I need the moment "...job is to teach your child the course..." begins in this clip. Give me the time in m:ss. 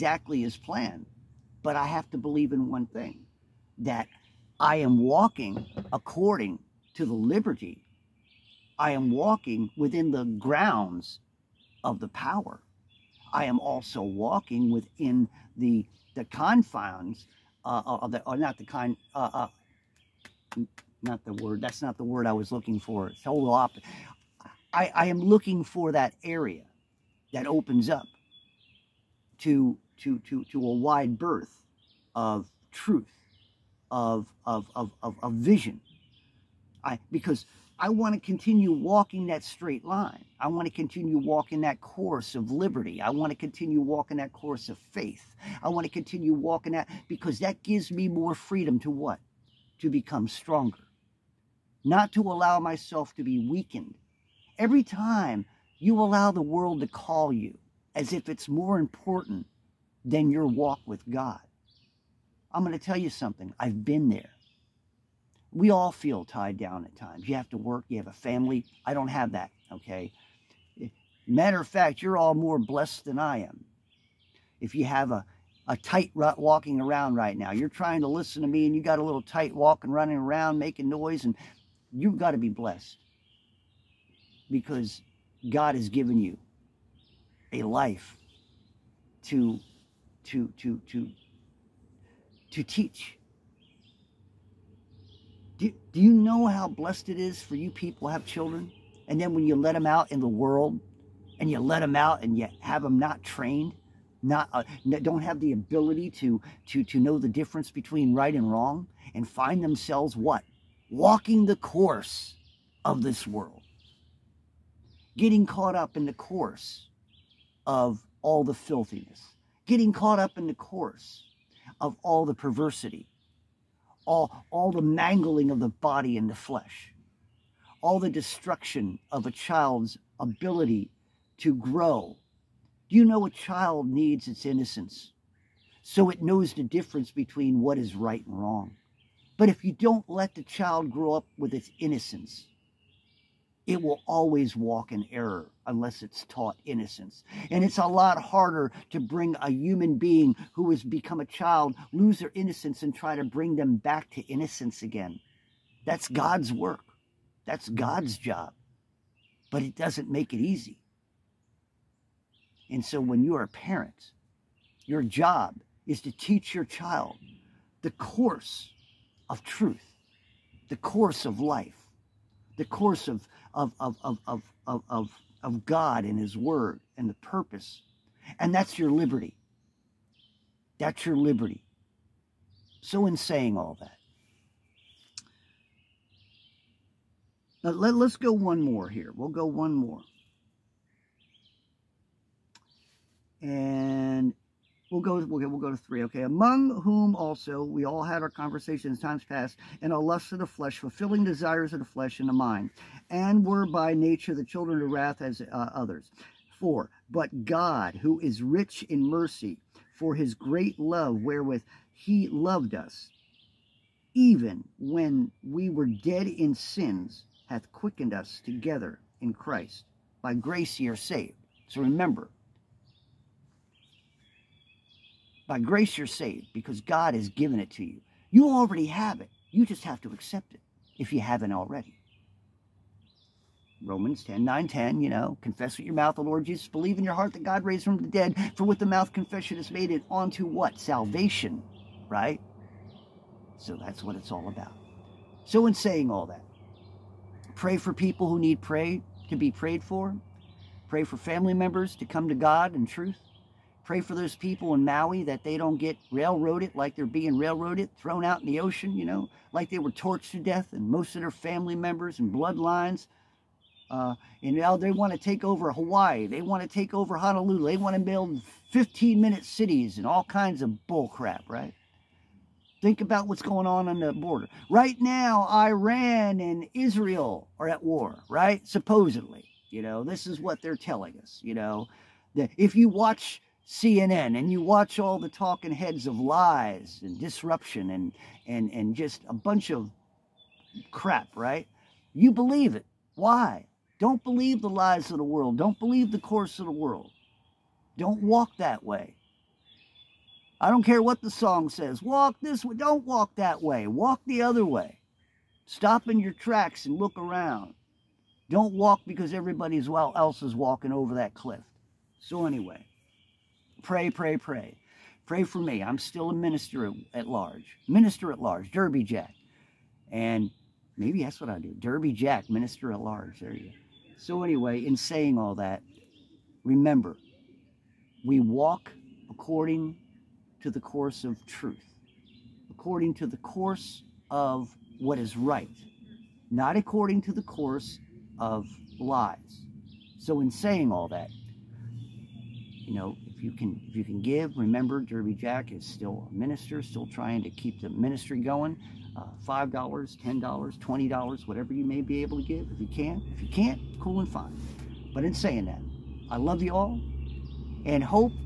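2:45.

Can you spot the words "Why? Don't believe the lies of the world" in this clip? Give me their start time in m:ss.
4:53.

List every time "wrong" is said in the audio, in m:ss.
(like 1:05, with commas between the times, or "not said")
1:48, 2:18.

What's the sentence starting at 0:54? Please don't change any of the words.
Every time you allow the world to call you, as if it's more important than your walk with God.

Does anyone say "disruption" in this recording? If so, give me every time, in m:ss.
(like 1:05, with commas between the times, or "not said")
4:47.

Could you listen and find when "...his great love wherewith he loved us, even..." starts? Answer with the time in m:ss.
3:30.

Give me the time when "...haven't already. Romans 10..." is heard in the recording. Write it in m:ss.
3:51.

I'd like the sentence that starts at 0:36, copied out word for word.
I because I want to continue walking that straight line.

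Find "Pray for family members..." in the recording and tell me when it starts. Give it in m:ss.
4:10.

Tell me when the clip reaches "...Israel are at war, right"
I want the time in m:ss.
4:36.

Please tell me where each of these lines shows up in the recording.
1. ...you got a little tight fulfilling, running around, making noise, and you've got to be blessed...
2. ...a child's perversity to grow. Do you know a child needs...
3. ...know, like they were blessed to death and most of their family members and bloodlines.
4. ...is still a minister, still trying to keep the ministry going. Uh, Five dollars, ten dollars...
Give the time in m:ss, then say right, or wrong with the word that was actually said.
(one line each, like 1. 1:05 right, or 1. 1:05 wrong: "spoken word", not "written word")
1. 1:18 wrong: "walking", not "fulfilling"
2. 2:09 wrong: "ability", not "perversity"
3. 4:19 wrong: "torched", not "blessed"
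4. 5:45 right.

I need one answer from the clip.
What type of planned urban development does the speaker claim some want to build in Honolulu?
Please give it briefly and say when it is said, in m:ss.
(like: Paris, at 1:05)
15 minute cities, at 4:28.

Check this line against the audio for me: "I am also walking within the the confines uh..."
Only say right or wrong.
right.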